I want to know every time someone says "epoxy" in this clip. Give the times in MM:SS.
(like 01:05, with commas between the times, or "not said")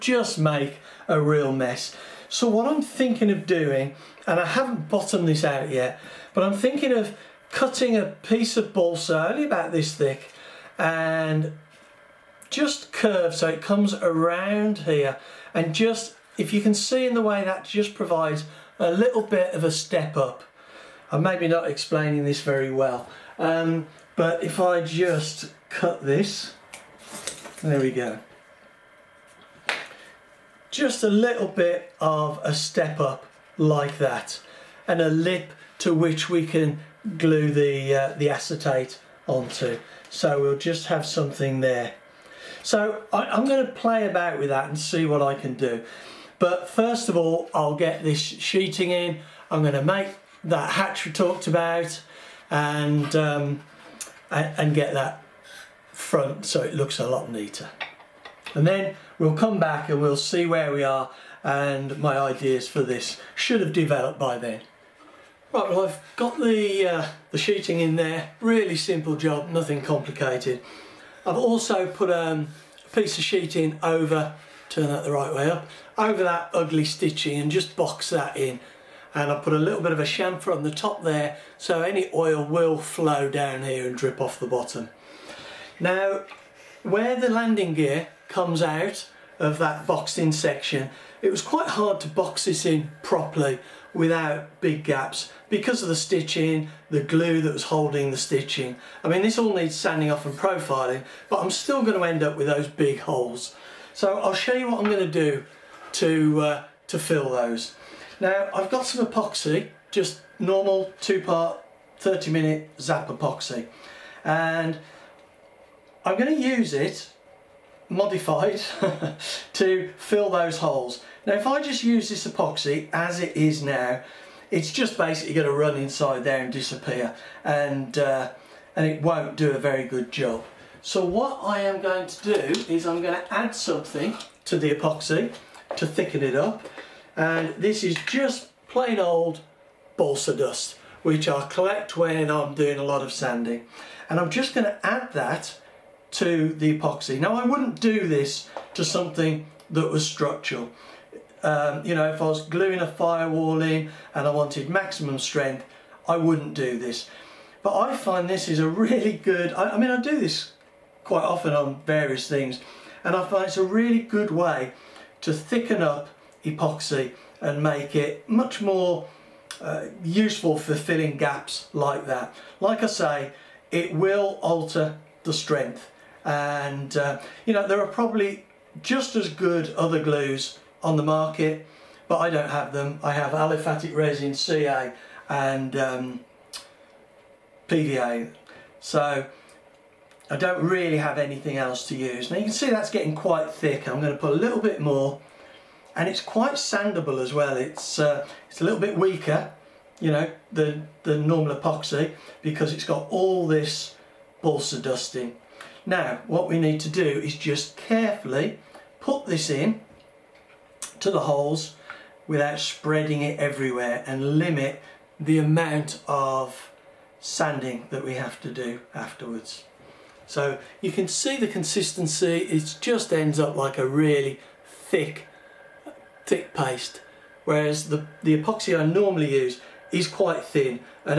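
01:49, 01:53, 02:02, 02:14, 02:26, 02:46, 03:21, 03:48.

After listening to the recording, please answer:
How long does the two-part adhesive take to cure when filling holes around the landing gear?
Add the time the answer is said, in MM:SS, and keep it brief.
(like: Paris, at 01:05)
30 minute, at 01:51.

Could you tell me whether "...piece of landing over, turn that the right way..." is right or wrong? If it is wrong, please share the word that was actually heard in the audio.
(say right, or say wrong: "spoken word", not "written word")
wrong: "sheeting", not "landing".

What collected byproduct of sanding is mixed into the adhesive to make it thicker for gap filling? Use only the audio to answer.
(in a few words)
balsa dust.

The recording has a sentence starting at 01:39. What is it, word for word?
I mean this all needs sanding off and profiling but I'm still going to end up with those big holes.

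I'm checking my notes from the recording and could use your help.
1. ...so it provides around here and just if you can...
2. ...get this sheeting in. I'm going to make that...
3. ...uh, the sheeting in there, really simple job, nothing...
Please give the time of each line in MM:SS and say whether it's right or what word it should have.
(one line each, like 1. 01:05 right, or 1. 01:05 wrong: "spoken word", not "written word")
1. 00:13 wrong: "comes", not "provides"
2. 00:47 right
3. 01:06 right.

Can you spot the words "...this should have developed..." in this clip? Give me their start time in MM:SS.
01:02.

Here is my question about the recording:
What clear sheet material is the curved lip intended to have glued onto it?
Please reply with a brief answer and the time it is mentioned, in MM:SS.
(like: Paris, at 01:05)
acetate, at 00:38.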